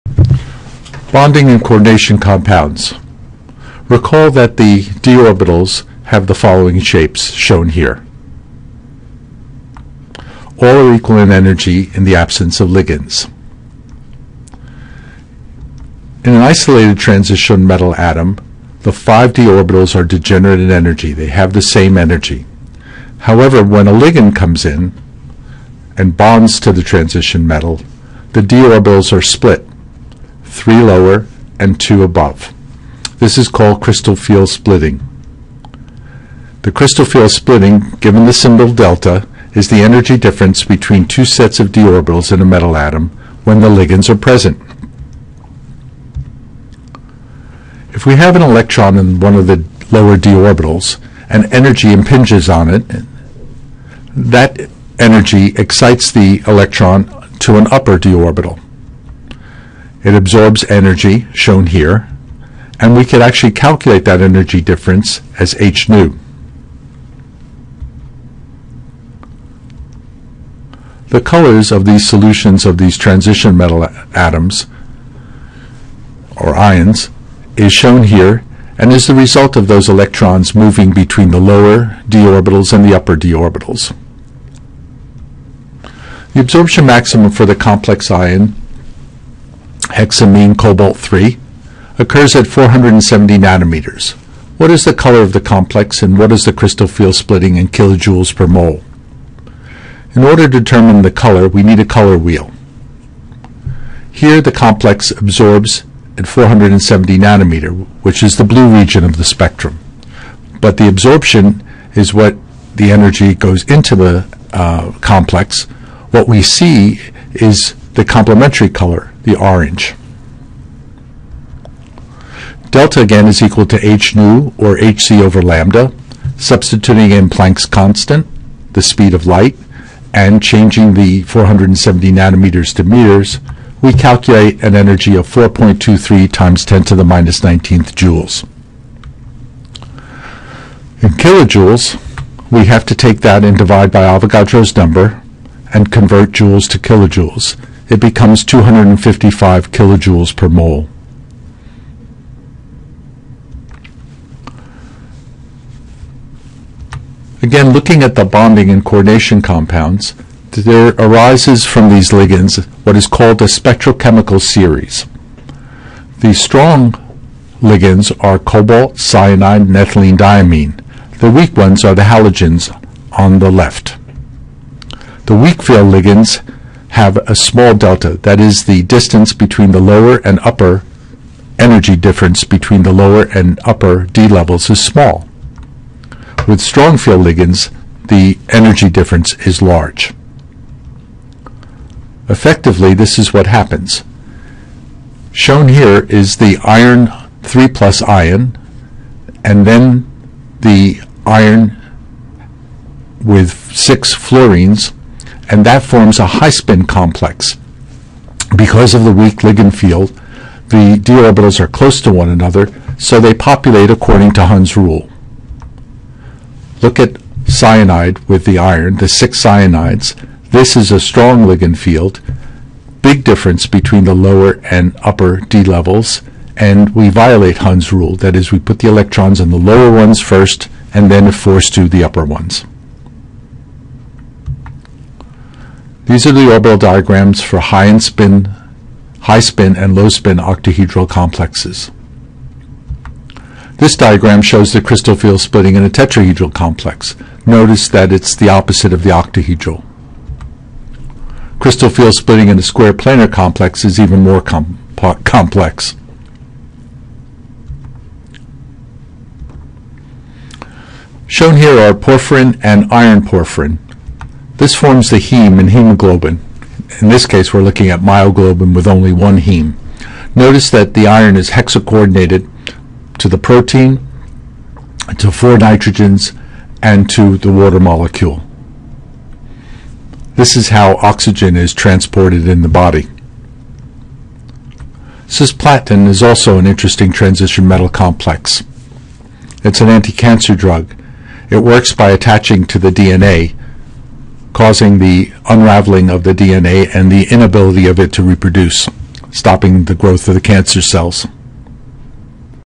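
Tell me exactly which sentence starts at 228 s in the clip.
That is, we put the electrons in the lower ones first, and then, force to, the upper ones.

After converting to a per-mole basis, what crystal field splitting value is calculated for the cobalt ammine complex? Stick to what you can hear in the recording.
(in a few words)
255 kJ/mol.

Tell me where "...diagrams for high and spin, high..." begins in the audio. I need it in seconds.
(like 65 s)
236 s.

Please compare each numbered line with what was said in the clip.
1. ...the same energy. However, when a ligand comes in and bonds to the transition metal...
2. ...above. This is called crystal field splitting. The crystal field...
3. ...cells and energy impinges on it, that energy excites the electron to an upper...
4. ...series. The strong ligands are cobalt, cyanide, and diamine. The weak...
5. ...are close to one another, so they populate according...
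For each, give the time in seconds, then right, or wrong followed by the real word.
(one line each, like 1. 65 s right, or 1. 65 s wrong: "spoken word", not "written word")
1. 21 s right
2. 32 s right
3. 50 s wrong: "orbitals", not "cells"
4. 164 s right
5. 211 s right.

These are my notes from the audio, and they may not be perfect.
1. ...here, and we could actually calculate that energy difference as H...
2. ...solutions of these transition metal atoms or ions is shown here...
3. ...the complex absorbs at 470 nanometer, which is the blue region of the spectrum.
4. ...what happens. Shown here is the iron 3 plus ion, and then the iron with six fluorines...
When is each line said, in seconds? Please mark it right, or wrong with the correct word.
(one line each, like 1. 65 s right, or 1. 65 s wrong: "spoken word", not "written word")
1. 61 s right
2. 72 s right
3. 104 s right
4. 193 s right.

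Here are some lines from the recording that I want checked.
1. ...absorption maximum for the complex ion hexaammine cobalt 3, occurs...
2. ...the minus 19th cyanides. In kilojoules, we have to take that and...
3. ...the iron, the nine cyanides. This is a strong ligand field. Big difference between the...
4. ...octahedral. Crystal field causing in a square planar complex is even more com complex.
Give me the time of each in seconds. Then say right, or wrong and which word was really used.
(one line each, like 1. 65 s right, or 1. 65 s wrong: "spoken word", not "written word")
1. 86 s right
2. 136 s wrong: "joules", not "cyanides"
3. 218 s wrong: "six", not "nine"
4. 249 s wrong: "splitting", not "causing".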